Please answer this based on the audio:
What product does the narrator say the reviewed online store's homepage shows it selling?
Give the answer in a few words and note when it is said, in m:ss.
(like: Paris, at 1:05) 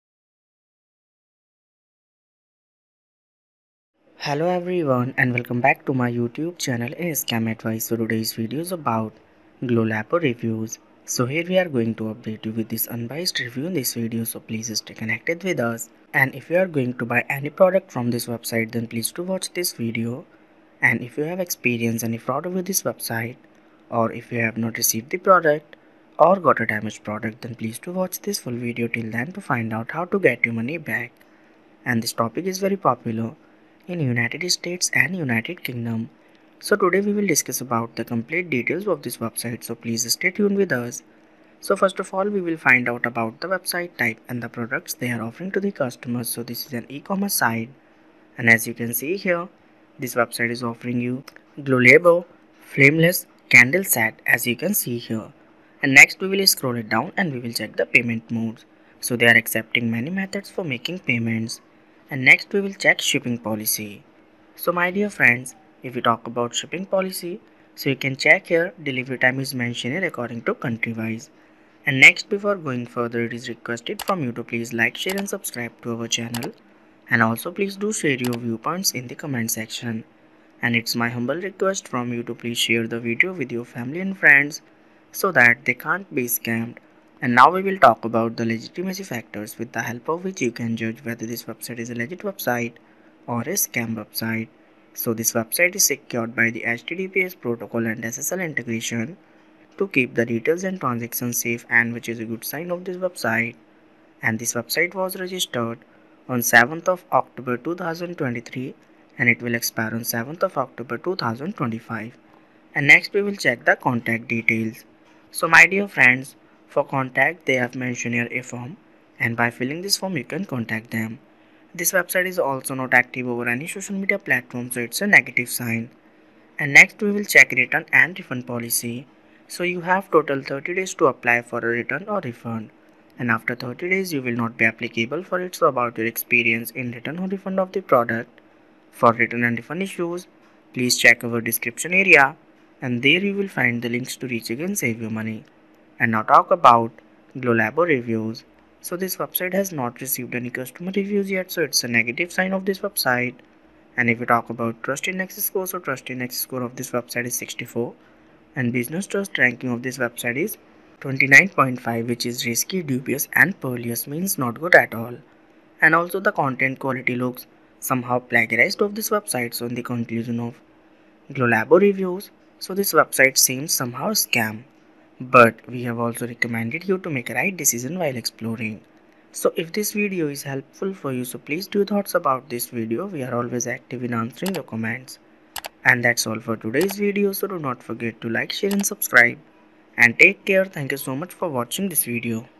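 flameless candle set, at 0:52.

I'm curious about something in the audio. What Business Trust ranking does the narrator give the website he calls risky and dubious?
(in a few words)
29.5.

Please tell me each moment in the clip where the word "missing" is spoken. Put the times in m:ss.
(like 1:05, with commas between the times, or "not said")
not said.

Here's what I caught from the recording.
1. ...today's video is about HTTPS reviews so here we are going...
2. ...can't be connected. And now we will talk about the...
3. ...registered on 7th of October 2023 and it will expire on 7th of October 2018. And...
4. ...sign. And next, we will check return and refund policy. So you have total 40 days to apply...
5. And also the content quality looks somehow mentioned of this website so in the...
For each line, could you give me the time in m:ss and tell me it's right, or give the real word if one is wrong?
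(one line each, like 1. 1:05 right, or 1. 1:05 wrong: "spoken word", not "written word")
1. 0:07 wrong: "Glowlabo", not "HTTPS"
2. 1:25 wrong: "scammed", not "connected"
3. 1:45 wrong: "2025", not "2018"
4. 2:05 wrong: "30", not "40"
5. 2:45 wrong: "plagiarized", not "mentioned".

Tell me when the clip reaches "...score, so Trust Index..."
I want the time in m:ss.
2:35.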